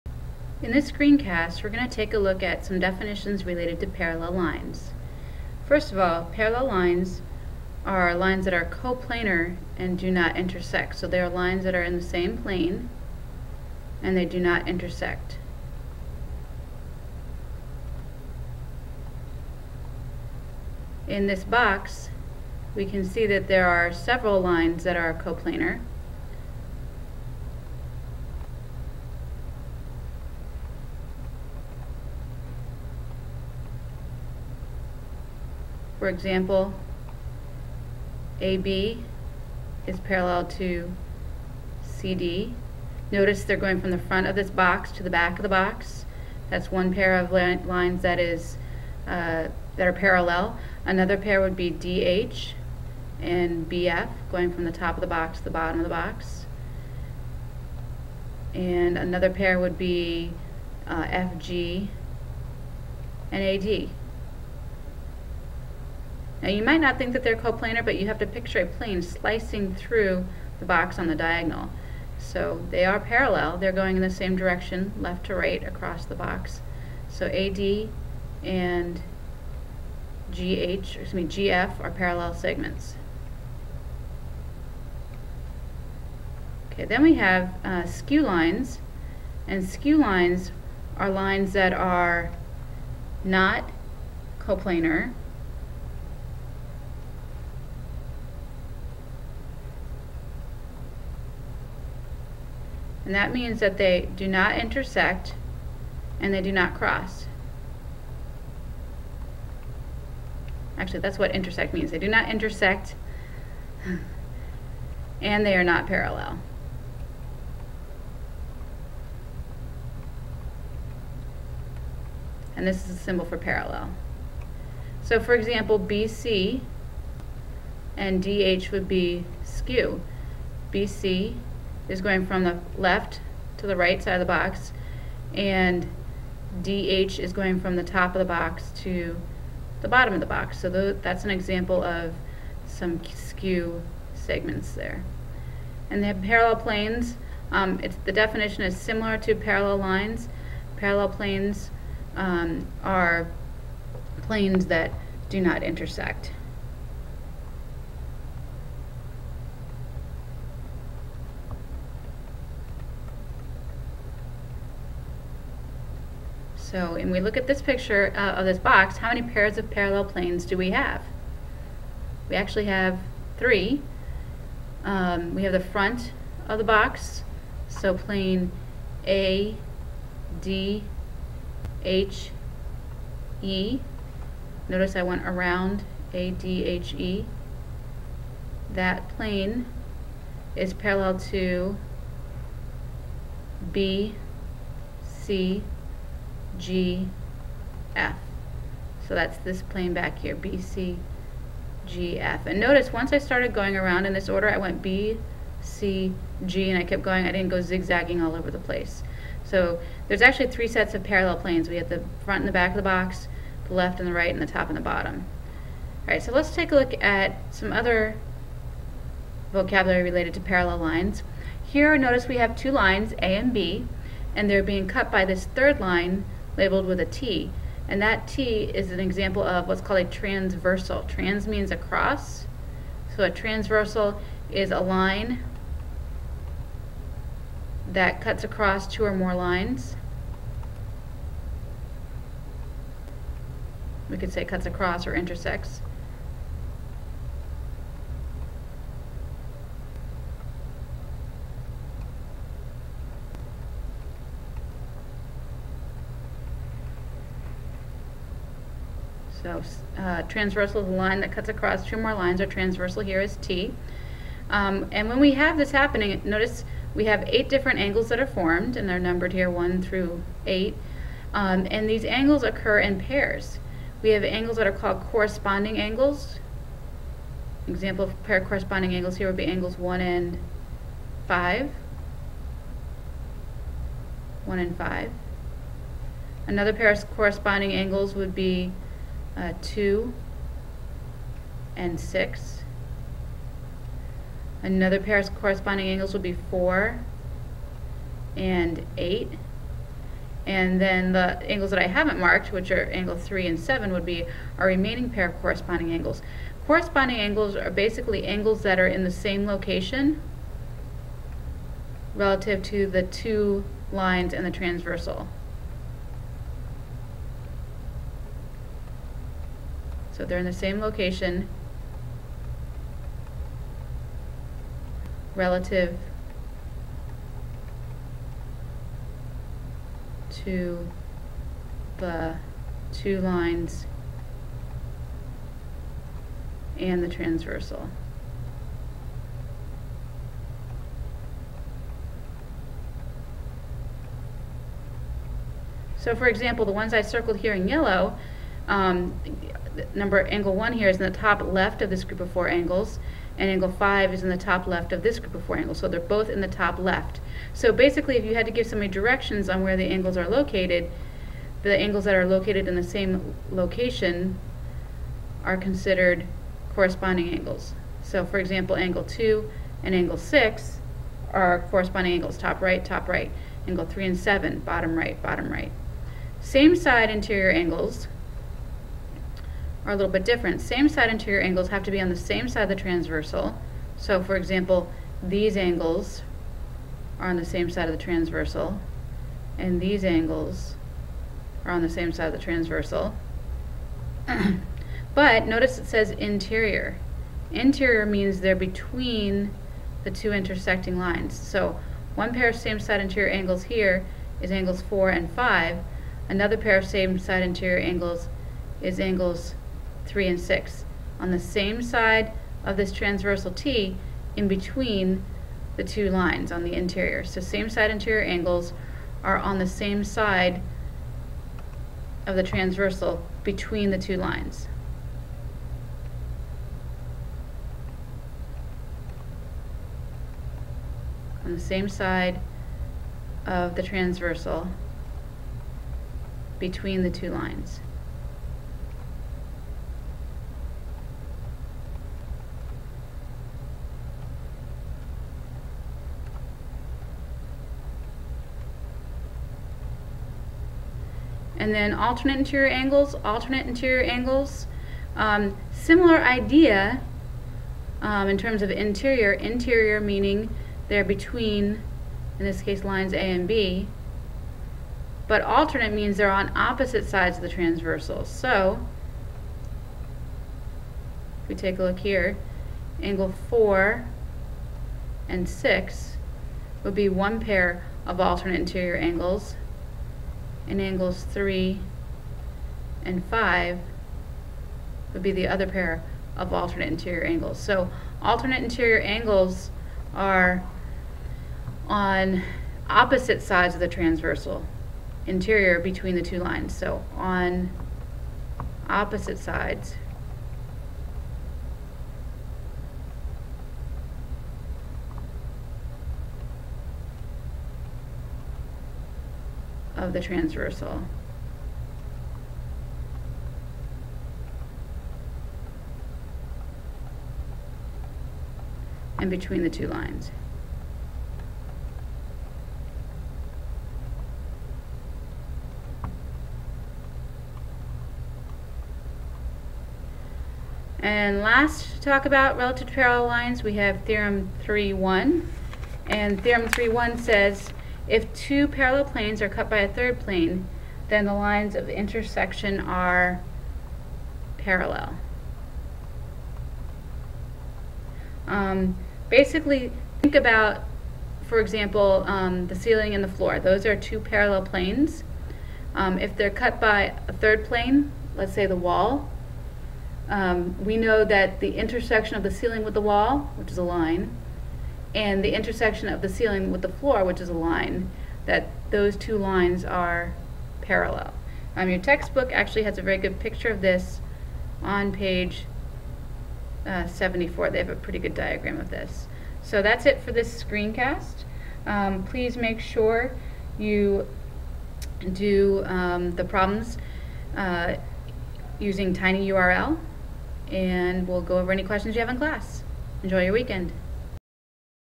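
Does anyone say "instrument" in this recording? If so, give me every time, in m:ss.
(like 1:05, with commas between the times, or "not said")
not said.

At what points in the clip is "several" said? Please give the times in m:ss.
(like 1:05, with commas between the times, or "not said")
0:23.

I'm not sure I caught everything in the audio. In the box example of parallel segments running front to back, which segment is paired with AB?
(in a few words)
CD.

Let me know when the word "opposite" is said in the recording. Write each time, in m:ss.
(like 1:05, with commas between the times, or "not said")
7:46, 8:12, 8:18.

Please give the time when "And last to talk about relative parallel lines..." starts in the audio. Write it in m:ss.
8:51.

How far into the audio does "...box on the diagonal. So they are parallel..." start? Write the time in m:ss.
1:10.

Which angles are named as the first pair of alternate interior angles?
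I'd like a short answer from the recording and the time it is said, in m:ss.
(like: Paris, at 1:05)
4 and 6, at 7:53.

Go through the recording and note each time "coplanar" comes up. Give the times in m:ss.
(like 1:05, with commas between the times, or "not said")
0:08, 0:25, 1:07, 1:34.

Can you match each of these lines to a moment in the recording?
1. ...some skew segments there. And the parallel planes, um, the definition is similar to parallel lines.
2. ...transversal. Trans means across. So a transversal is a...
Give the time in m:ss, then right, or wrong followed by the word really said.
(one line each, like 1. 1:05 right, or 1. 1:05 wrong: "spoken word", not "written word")
1. 2:22 right
2. 3:50 right.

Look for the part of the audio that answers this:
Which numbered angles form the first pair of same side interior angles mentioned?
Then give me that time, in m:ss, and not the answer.
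6:44.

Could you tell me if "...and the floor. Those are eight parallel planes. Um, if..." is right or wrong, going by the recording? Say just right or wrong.
wrong.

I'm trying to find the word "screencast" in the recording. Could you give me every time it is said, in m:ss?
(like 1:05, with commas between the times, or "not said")
0:00, 9:40.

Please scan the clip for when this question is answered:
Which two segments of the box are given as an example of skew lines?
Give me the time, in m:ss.
2:05.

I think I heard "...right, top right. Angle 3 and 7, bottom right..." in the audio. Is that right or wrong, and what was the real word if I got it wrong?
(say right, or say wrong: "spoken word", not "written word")
right.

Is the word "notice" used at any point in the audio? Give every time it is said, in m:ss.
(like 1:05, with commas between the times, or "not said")
0:43, 3:04, 3:22, 3:41, 4:26, 6:35.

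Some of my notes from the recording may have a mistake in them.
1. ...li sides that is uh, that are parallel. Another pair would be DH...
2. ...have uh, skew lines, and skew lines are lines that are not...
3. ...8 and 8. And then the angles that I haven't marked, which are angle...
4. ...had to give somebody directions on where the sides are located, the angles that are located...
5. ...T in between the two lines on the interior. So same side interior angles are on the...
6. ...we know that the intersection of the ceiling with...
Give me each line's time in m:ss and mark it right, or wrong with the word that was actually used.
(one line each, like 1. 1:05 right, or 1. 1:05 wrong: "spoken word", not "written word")
1. 0:47 wrong: "lines", not "sides"
2. 1:27 right
3. 4:56 wrong: "4", not "8"
4. 5:58 wrong: "angles", not "sides"
5. 6:53 right
6. 9:20 right.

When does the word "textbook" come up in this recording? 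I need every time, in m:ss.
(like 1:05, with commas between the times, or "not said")
9:31.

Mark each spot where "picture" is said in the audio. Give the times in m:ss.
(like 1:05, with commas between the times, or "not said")
1:08, 2:47, 9:33.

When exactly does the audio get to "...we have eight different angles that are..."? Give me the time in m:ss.
4:26.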